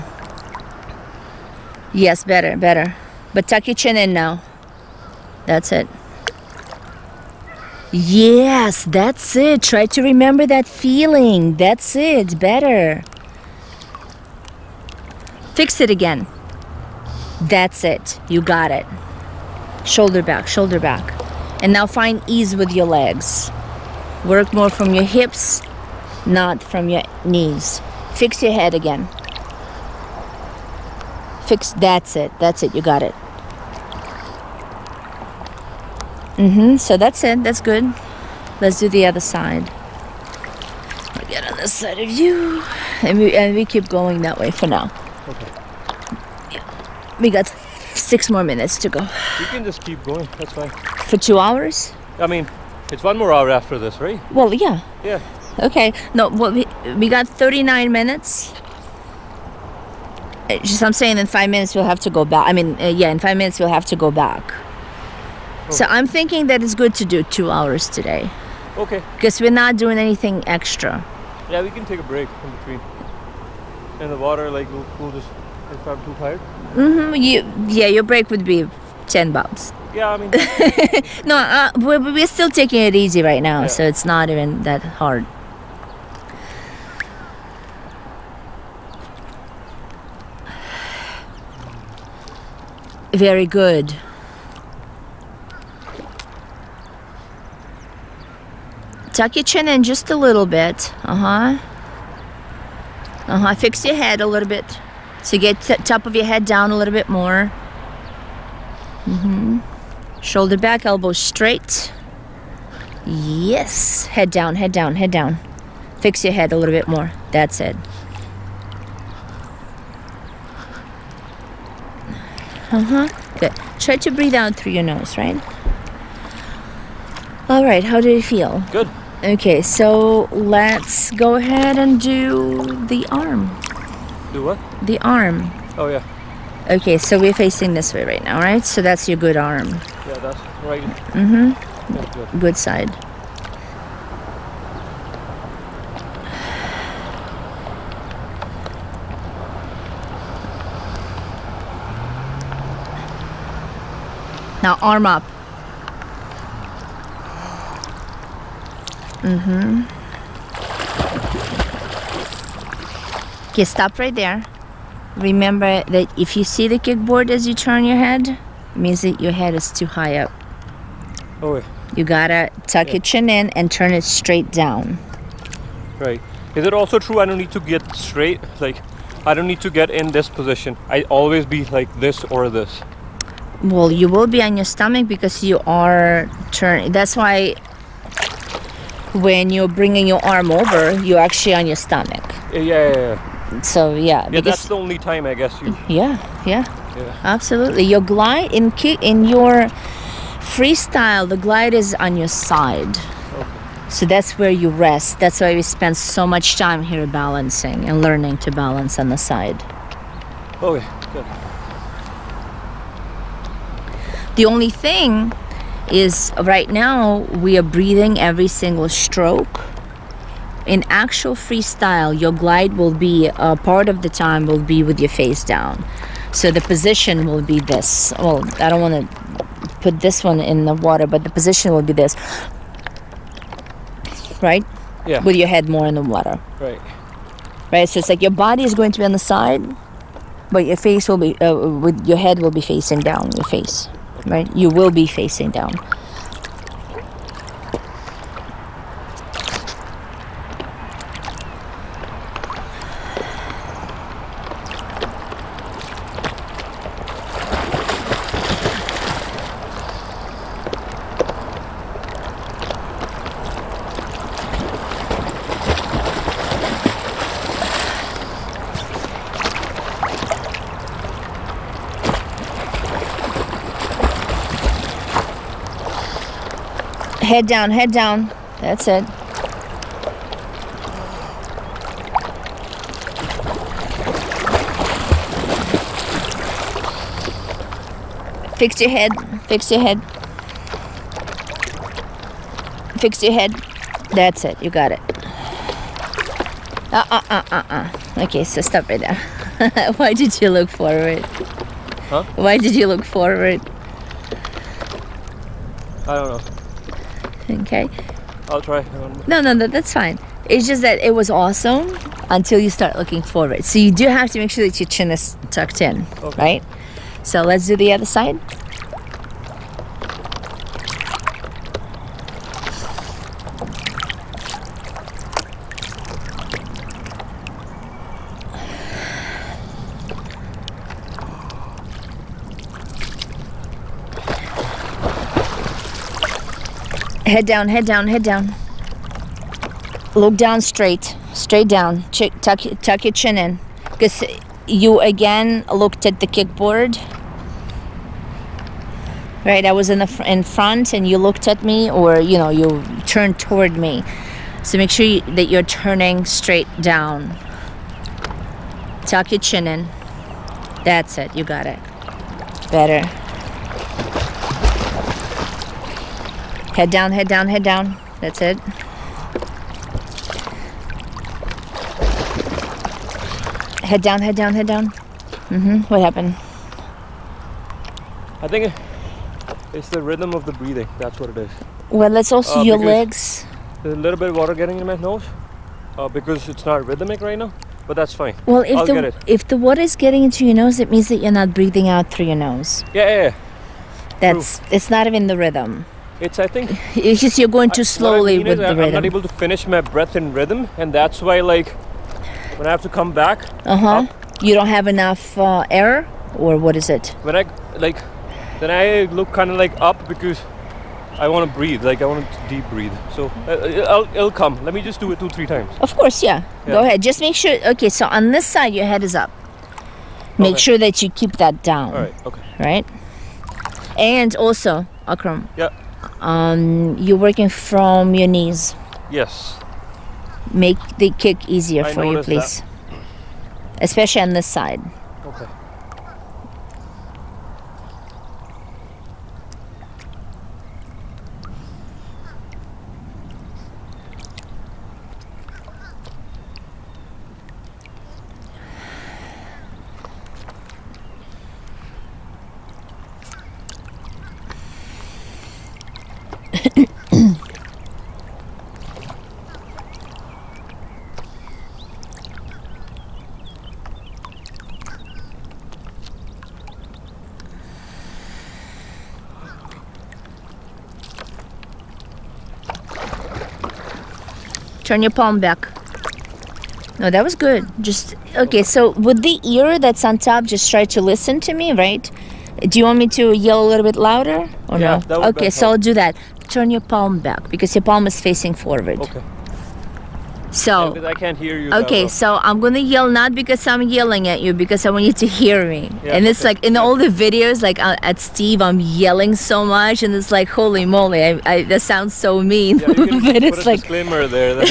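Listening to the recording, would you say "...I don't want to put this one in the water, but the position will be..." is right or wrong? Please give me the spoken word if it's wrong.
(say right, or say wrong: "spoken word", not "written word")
right.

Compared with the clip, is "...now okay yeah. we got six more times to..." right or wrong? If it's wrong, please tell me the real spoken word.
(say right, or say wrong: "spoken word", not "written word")
wrong: "minutes", not "times".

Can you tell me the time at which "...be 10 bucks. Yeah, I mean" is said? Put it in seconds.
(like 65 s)
78 s.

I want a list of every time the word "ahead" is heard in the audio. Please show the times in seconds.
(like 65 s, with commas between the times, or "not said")
131 s, 416 s.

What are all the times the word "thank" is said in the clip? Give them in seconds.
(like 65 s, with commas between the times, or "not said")
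not said.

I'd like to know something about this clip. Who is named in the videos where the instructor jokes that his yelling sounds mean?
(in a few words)
Steve.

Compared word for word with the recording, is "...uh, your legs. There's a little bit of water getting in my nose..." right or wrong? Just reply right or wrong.
right.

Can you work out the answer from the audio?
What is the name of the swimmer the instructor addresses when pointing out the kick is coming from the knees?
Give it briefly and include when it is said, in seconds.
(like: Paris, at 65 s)
Akram, at 425 s.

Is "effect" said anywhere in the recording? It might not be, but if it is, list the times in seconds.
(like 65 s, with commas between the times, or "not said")
not said.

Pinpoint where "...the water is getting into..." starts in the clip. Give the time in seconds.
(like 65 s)
389 s.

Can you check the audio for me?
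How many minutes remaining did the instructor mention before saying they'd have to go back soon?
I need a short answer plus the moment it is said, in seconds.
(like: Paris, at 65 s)
39, at 56 s.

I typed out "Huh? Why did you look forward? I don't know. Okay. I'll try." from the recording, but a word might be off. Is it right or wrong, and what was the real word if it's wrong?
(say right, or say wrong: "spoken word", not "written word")
right.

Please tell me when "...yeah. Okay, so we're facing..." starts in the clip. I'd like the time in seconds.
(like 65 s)
135 s.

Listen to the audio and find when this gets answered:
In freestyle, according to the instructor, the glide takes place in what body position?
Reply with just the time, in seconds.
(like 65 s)
201 s.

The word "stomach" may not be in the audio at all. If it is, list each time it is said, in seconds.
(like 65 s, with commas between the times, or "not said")
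184 s, 191 s.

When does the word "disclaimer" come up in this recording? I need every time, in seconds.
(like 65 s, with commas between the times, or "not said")
503 s.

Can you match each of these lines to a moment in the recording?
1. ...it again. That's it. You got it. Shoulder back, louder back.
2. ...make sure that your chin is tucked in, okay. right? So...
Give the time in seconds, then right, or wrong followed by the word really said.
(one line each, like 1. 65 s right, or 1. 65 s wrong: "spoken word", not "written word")
1. 15 s wrong: "shoulder", not "louder"
2. 314 s right.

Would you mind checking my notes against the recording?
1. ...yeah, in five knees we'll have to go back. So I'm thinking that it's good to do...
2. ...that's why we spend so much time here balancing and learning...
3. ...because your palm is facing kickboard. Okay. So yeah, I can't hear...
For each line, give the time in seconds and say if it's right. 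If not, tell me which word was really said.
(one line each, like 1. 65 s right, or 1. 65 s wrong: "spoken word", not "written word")
1. 62 s wrong: "minutes", not "knees"
2. 205 s right
3. 487 s wrong: "forward", not "kickboard".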